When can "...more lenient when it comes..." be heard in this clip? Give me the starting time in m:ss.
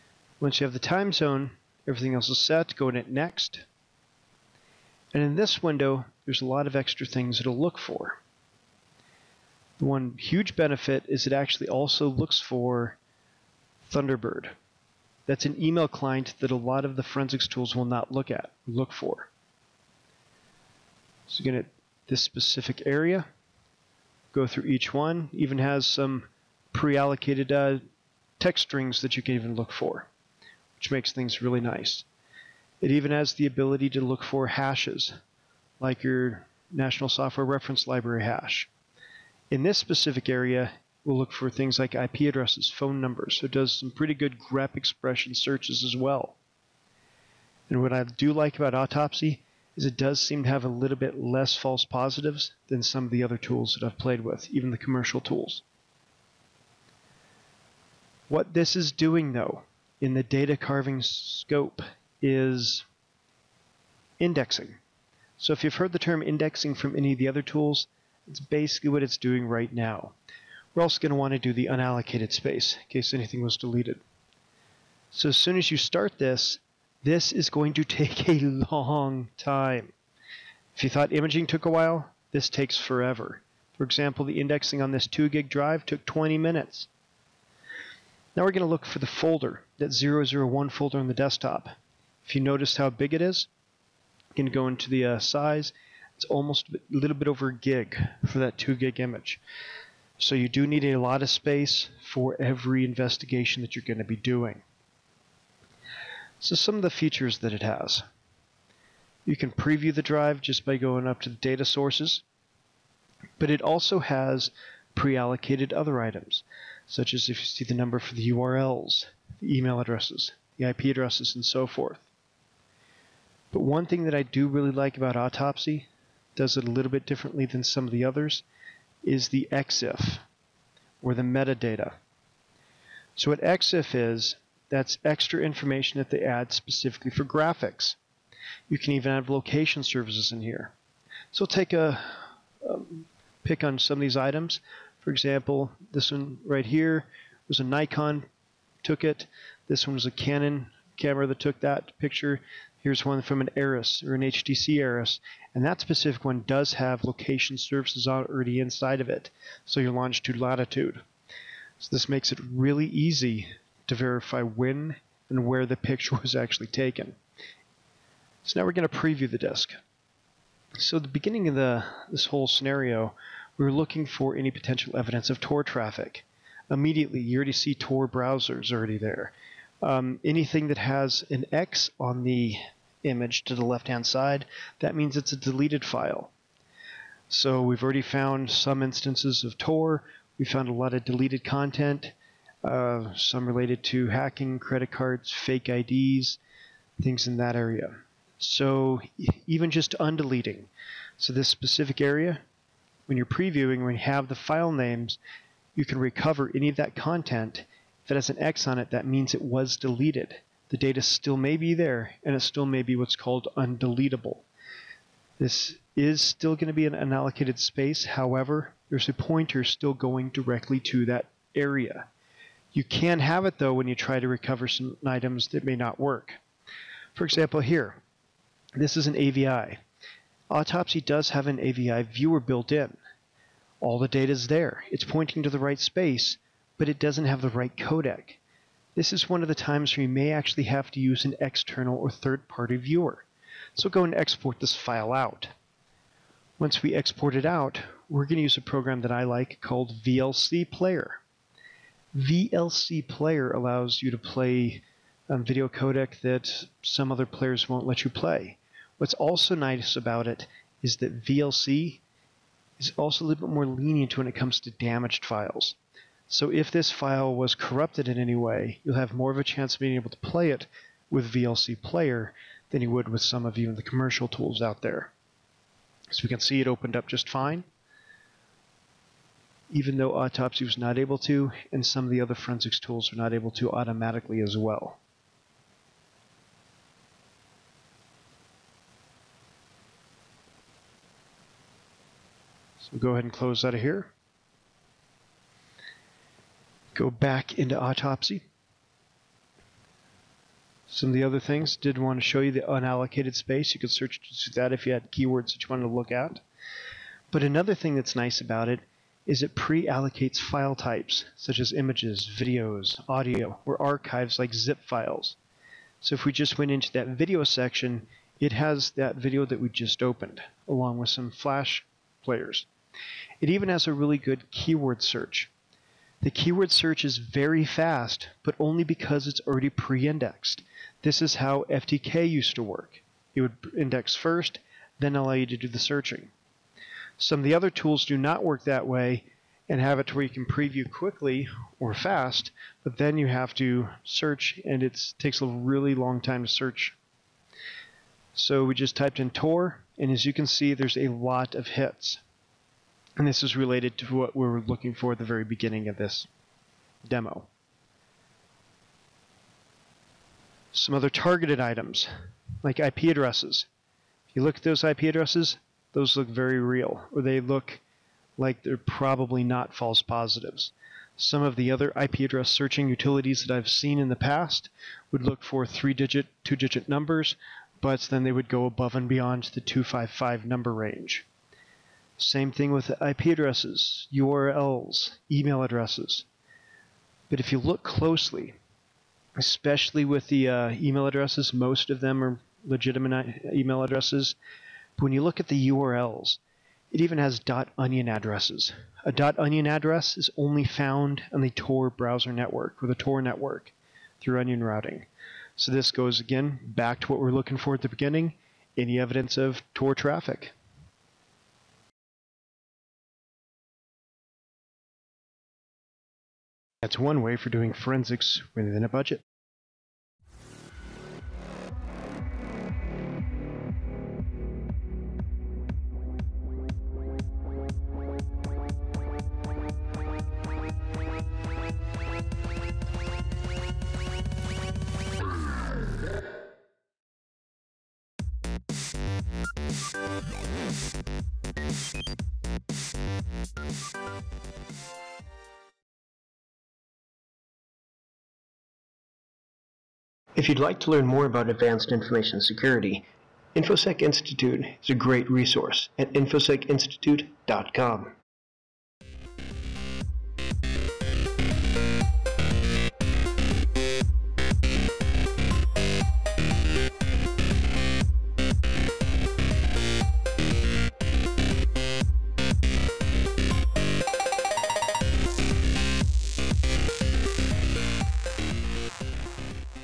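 4:23.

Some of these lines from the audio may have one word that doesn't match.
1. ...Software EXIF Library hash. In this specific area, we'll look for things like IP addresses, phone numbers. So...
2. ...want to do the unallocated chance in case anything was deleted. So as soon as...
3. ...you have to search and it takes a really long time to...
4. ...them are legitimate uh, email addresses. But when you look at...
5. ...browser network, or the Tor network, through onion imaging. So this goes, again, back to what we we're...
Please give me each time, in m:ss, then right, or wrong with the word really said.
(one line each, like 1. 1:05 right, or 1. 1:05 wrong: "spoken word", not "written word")
1. 0:37 wrong: "Reference", not "EXIF"
2. 1:11 wrong: "space", not "chance"
3. 5:43 right
4. 6:32 right
5. 6:41 wrong: "routing", not "imaging".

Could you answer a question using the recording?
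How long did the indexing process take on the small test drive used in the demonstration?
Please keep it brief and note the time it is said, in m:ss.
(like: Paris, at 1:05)
20 minutes, at 1:26.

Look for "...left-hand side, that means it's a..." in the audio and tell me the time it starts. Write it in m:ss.
3:03.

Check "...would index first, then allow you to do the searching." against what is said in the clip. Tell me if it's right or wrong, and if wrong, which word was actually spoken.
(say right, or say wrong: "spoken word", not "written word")
right.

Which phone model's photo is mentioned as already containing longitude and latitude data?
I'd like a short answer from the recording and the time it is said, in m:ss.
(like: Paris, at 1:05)
HTC Aris, at 2:34.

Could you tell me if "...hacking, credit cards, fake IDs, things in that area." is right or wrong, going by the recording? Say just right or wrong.
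right.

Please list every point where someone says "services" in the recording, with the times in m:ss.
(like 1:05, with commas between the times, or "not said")
2:19, 2:37.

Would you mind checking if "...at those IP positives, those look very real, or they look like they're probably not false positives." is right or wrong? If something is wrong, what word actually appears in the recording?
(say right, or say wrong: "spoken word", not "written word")
wrong: "addresses", not "positives".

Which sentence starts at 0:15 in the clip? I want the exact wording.
That's an email client that a lot of the forensics tools will not look at, look for.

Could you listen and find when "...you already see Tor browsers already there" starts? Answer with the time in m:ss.
2:57.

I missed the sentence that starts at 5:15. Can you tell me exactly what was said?
So if we just went into that video section, it has that video that we just opened, along with some flash players.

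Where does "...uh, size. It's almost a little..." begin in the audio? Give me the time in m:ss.
1:35.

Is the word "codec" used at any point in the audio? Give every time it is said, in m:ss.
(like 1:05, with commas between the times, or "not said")
3:57, 4:15.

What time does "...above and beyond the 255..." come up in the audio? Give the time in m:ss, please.
6:18.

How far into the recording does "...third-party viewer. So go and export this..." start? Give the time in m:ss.
4:02.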